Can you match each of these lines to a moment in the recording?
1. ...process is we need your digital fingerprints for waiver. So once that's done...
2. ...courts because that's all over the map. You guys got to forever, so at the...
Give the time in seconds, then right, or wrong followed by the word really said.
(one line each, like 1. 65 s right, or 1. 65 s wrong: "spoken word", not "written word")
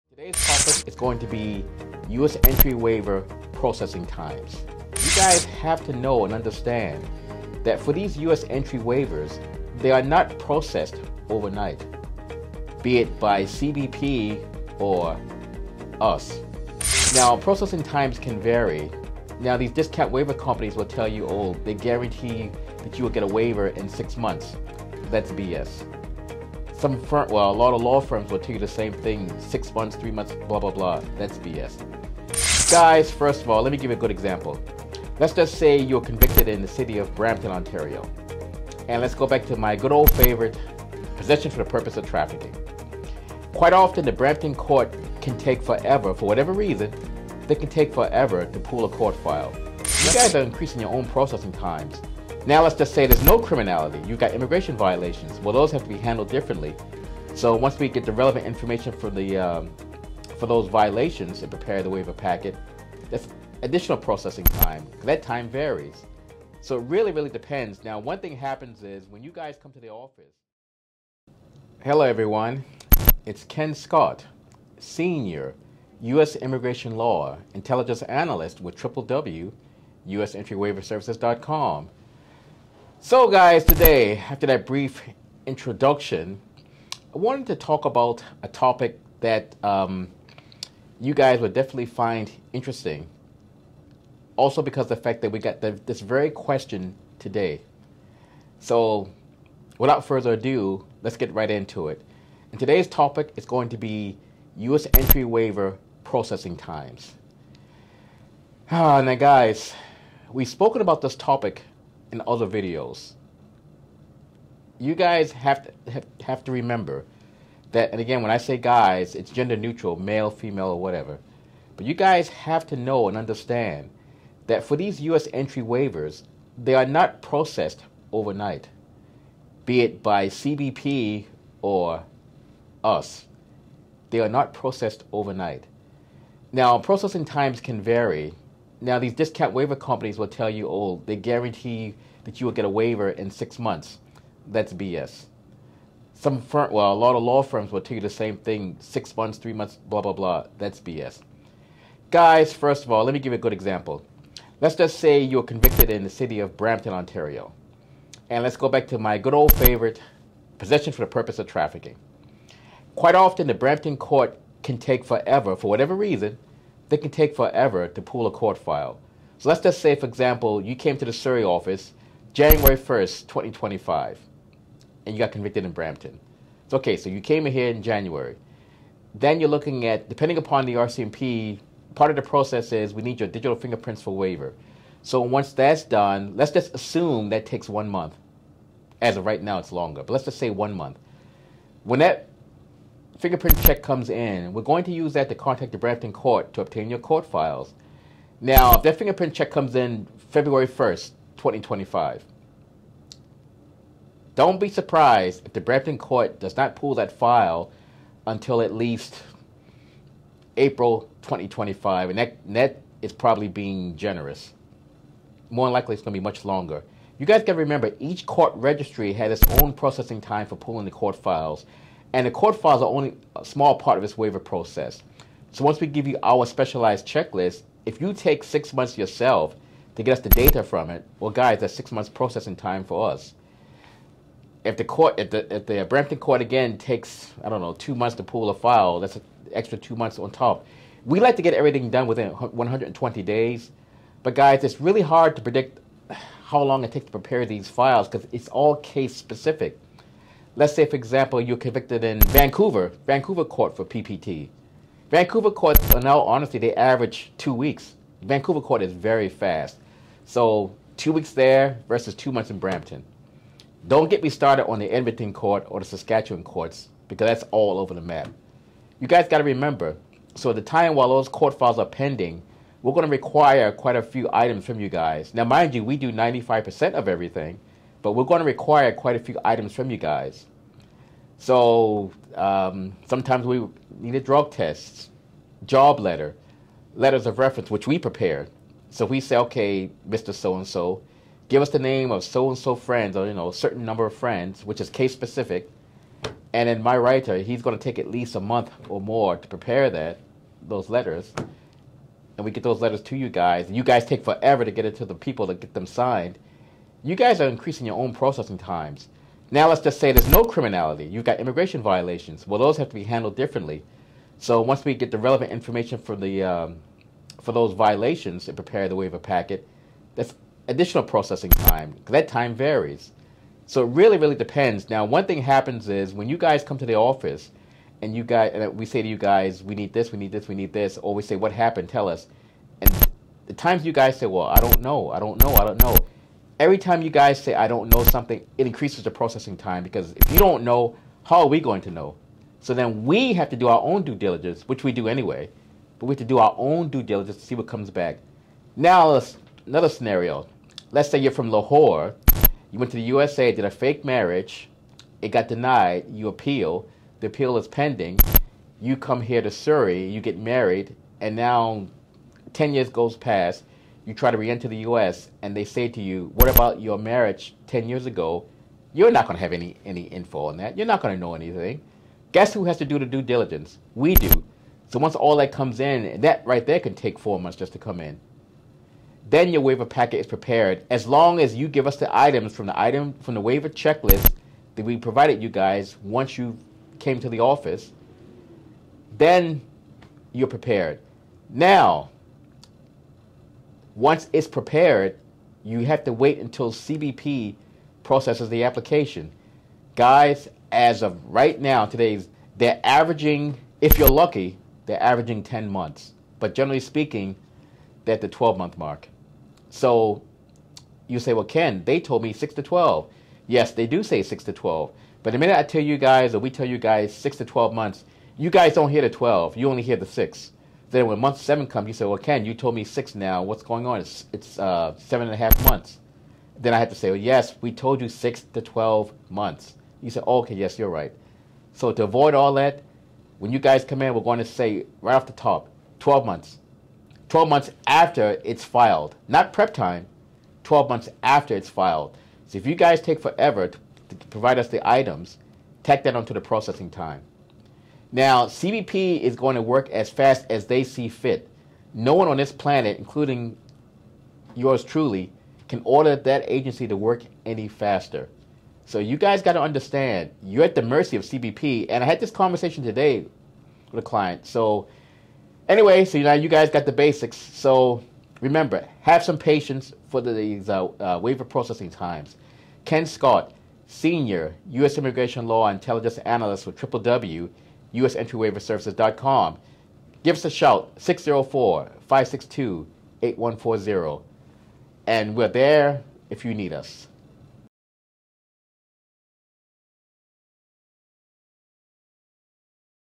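1. 182 s right
2. 266 s wrong: "remember", not "forever".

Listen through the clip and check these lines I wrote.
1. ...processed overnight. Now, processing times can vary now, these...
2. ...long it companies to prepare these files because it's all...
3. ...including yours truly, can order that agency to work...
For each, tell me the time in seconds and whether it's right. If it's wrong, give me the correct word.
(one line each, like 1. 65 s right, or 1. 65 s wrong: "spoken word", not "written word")
1. 134 s right
2. 246 s wrong: "takes", not "companies"
3. 452 s right.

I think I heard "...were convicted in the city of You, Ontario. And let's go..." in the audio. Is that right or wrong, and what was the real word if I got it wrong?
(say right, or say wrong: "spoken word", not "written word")
wrong: "Brampton", not "You".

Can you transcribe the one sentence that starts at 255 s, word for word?
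Vancouver courts are uh, now, honestly, they average two weeks.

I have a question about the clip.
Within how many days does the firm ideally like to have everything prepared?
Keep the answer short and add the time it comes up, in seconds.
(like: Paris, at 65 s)
120, at 242 s.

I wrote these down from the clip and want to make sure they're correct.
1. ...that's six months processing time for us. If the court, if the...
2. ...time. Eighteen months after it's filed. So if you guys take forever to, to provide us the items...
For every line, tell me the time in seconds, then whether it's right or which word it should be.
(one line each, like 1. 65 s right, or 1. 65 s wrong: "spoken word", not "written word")
1. 231 s right
2. 439 s wrong: "Twelve", not "Eighteen".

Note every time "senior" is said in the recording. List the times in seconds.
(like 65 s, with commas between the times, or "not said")
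74 s, 473 s.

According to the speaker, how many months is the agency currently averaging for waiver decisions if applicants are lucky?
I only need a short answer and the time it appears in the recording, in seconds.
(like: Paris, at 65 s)
10 months, at 405 s.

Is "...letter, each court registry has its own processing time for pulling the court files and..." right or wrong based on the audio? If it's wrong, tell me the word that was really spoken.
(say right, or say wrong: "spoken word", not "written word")
wrong: "remember", not "letter".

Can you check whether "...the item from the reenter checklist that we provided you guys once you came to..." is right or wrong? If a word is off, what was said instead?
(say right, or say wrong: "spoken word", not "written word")
wrong: "waiver", not "reenter".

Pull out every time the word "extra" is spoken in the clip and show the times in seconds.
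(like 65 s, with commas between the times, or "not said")
239 s.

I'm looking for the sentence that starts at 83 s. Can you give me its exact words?
So, guys, today, after that brief introduction, I wanted to talk about a topic that um, you guys would definitely find interesting.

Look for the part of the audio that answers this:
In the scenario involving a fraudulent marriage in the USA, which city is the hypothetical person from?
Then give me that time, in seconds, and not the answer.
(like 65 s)
351 s.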